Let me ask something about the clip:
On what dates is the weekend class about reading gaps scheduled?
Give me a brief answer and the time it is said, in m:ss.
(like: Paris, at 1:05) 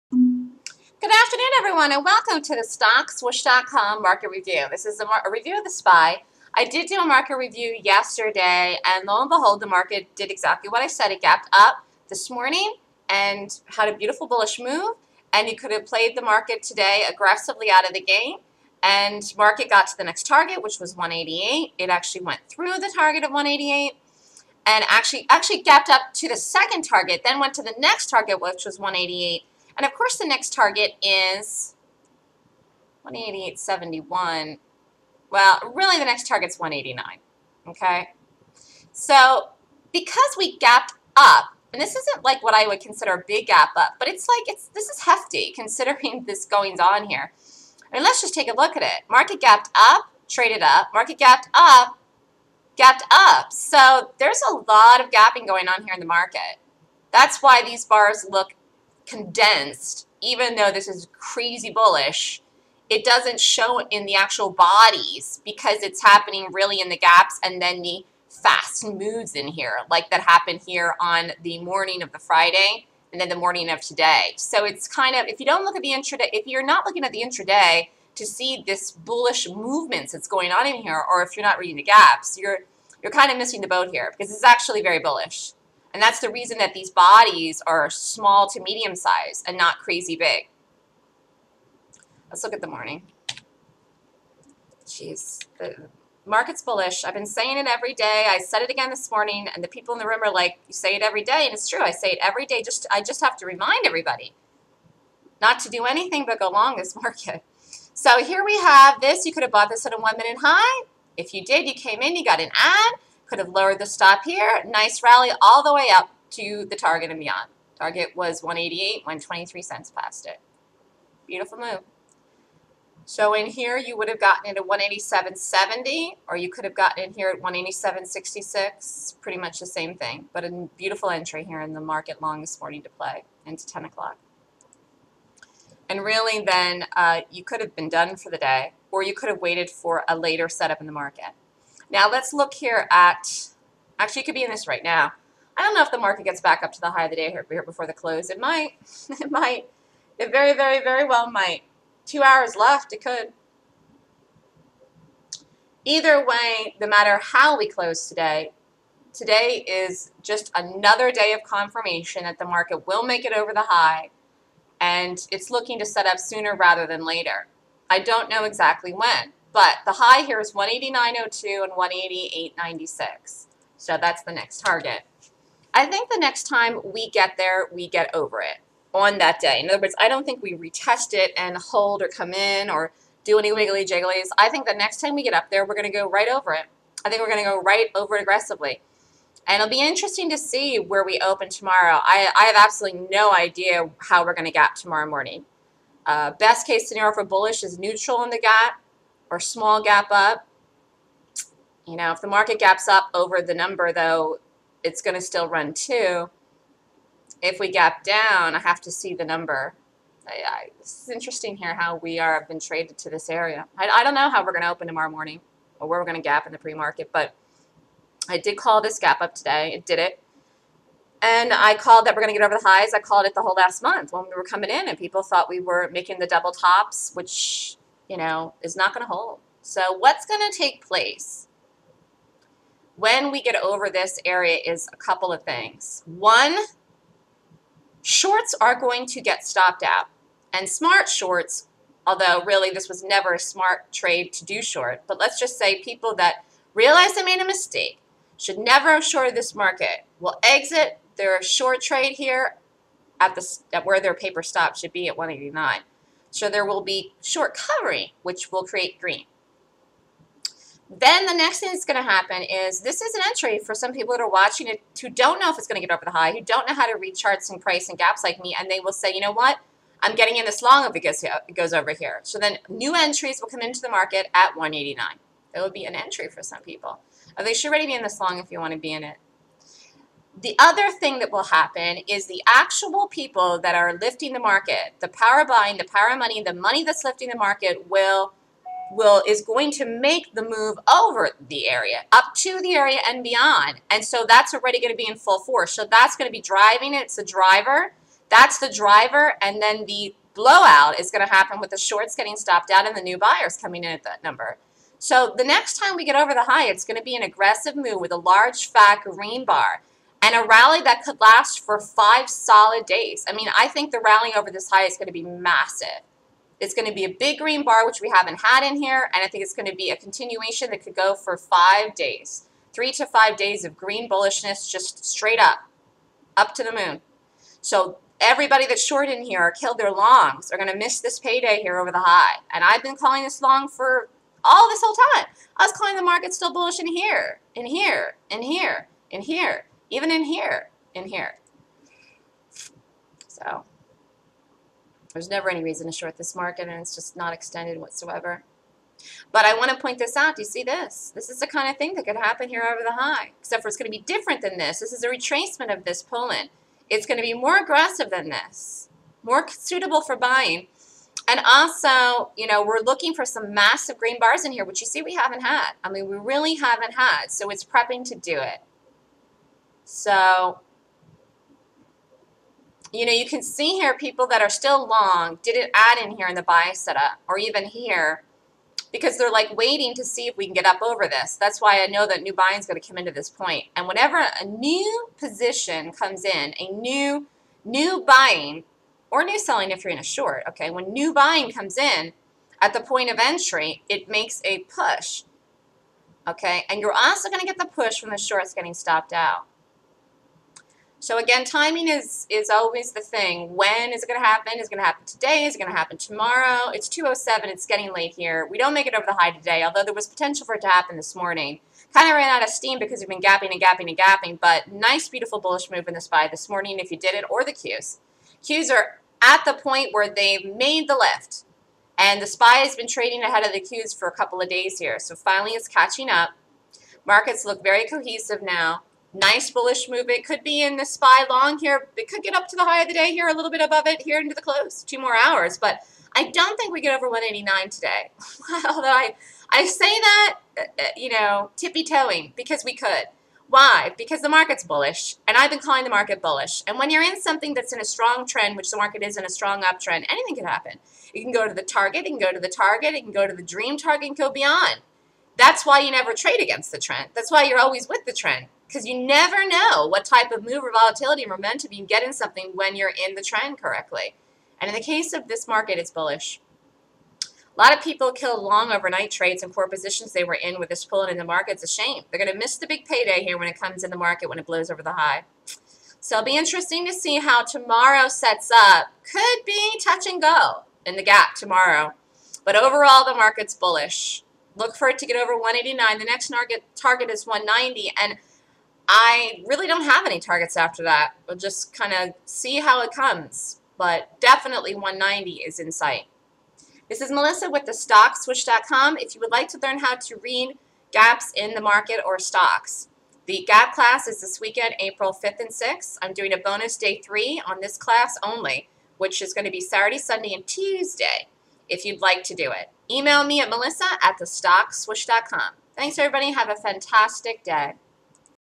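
April 5th and 6th, at 8:24.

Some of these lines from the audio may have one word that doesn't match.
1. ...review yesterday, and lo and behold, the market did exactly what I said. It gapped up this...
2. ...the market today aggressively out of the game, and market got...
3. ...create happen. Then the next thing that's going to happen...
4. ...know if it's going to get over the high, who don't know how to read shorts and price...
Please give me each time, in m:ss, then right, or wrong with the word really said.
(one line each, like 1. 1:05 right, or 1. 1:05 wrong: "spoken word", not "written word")
1. 0:07 right
2. 0:16 right
3. 4:18 wrong: "green", not "happen"
4. 4:25 wrong: "charts", not "shorts".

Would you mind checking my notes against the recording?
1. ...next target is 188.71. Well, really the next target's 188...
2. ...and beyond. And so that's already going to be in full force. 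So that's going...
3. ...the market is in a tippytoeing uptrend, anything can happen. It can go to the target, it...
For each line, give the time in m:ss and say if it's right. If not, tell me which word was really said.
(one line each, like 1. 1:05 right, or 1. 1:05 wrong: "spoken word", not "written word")
1. 0:30 wrong: "189", not "188"
2. 4:53 right
3. 7:28 wrong: "strong", not "tippytoeing".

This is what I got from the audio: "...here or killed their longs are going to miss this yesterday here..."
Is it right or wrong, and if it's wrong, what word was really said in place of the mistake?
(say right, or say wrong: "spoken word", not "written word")
wrong: "payday", not "yesterday".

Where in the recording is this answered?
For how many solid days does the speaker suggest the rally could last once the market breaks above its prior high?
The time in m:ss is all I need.
5:11.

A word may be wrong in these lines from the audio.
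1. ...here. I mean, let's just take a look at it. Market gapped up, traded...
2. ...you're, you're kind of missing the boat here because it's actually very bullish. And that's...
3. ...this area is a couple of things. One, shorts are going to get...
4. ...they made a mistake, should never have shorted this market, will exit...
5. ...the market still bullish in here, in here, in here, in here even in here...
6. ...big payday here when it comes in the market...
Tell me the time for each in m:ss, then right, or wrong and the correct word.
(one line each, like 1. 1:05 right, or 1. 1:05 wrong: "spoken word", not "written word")
1. 0:47 right
2. 1:22 right
3. 3:53 right
4. 4:07 right
5. 5:35 right
6. 7:52 right.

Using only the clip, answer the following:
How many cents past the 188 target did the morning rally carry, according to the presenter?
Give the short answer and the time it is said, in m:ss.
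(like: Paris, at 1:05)
23 cents, at 1:59.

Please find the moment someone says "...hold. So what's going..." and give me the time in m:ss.
3:49.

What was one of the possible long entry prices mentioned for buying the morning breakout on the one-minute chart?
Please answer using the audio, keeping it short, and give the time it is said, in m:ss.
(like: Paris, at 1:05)
187.66, at 2:07.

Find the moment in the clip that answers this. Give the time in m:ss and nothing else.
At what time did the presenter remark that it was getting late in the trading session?
6:46.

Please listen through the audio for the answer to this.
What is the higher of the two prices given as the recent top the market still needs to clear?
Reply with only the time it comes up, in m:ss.
2:50.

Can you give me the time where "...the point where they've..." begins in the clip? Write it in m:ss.
6:59.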